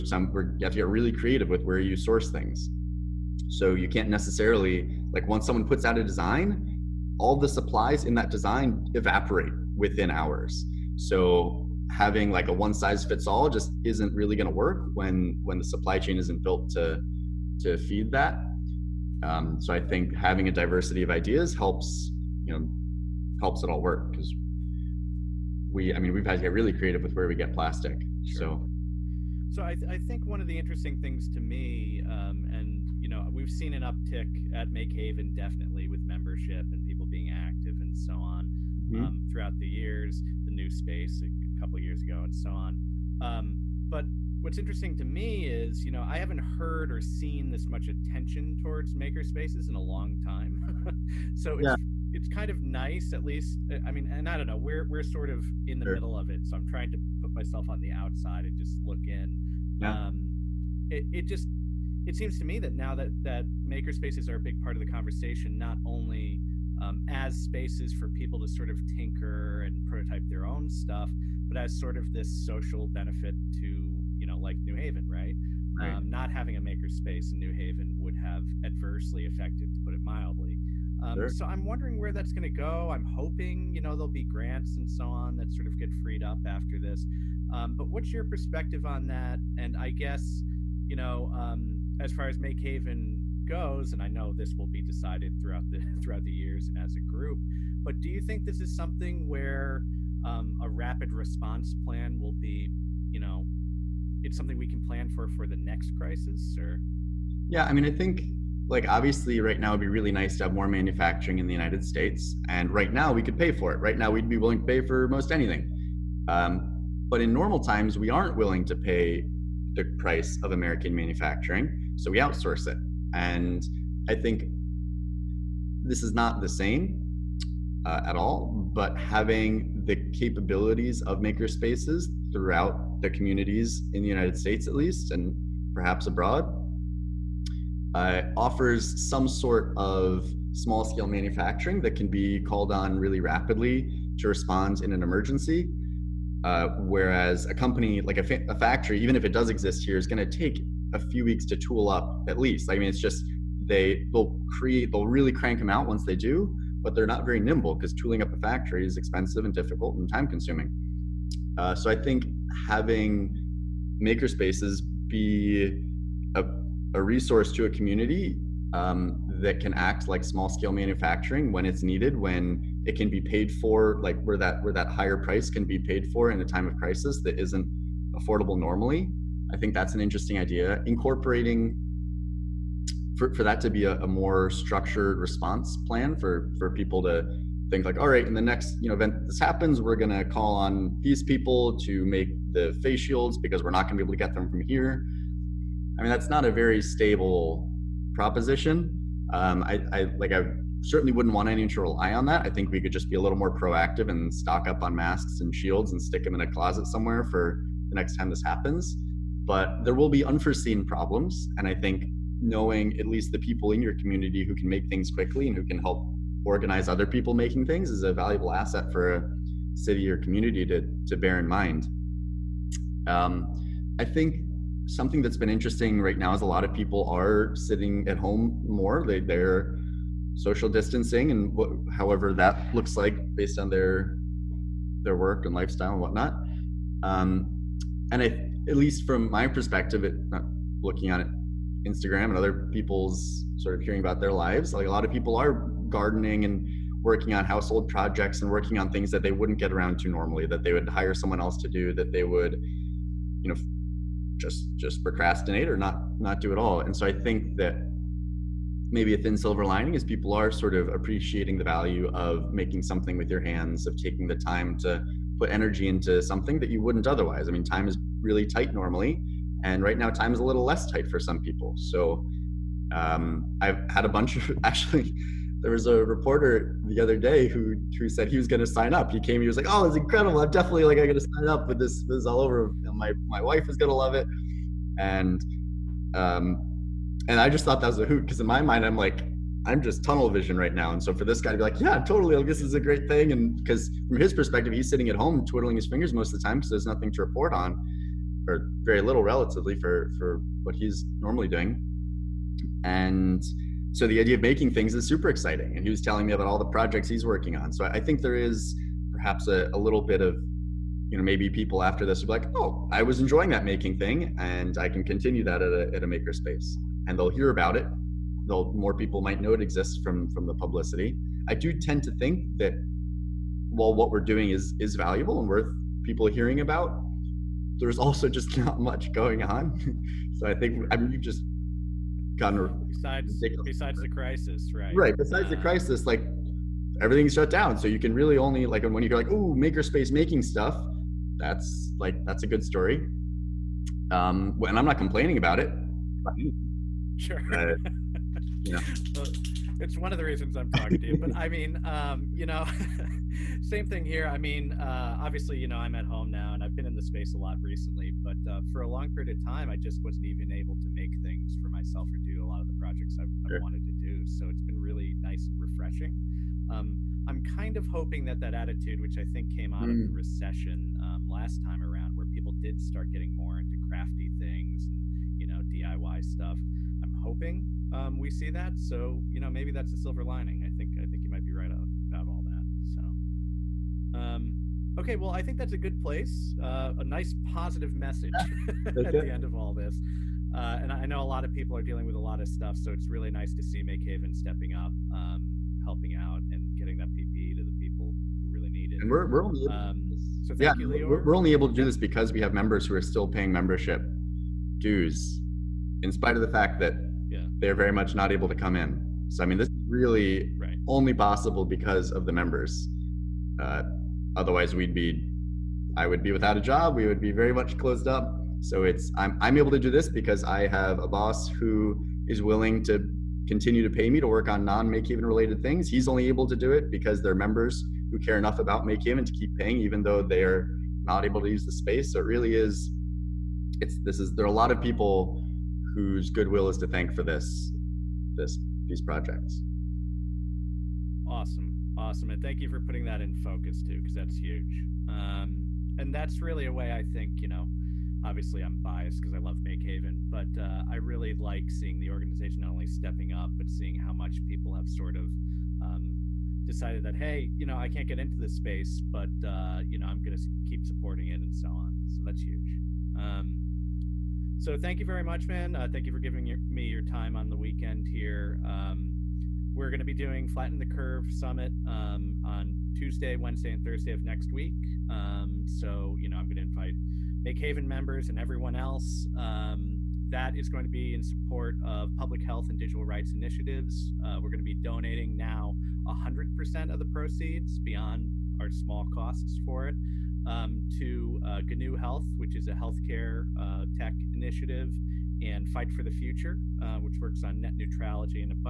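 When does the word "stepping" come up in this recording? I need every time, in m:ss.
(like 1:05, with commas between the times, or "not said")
6:34, 7:32.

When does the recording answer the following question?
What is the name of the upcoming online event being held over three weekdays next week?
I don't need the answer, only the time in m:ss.
7:50.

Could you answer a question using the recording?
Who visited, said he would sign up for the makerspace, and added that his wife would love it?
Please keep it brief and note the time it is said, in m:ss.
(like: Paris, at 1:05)
A reporter, at 4:36.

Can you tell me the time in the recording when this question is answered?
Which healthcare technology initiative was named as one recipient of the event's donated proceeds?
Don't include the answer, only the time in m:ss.
8:11.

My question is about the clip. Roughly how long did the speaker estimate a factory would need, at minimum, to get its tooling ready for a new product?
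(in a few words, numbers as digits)
A few weeks.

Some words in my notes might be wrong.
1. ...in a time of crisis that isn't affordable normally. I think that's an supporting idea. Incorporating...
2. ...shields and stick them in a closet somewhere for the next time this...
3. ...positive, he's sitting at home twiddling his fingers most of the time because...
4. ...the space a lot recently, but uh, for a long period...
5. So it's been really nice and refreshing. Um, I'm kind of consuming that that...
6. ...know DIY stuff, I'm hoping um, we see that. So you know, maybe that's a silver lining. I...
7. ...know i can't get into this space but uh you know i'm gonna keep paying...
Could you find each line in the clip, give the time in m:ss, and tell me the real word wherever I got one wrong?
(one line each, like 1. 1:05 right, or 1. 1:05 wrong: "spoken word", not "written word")
1. 2:56 wrong: "interesting", not "supporting"
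2. 3:25 right
3. 4:54 wrong: "perspective", not "positive"
4. 5:56 right
5. 6:04 wrong: "hoping", not "consuming"
6. 6:15 right
7. 7:37 wrong: "supporting", not "paying".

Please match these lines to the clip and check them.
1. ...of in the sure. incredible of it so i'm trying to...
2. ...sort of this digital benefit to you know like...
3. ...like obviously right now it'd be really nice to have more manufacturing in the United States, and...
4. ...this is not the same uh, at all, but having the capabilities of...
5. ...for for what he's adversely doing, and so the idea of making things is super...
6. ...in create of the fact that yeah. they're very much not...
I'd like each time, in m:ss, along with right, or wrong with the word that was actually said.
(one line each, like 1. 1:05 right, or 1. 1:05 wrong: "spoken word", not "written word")
1. 0:55 wrong: "middle", not "incredible"
2. 1:11 wrong: "social", not "digital"
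3. 1:48 right
4. 2:05 right
5. 4:59 wrong: "normally", not "adversely"
6. 6:46 wrong: "spite", not "create".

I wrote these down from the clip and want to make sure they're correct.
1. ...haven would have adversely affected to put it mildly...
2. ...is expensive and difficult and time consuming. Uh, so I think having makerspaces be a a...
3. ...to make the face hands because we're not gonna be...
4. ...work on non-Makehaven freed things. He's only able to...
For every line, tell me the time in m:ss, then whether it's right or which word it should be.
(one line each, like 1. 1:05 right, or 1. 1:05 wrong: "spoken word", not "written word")
1. 1:17 right
2. 2:38 right
3. 3:11 wrong: "shields", not "hands"
4. 7:04 wrong: "related", not "freed".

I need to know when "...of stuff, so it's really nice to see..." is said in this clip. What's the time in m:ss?
6:32.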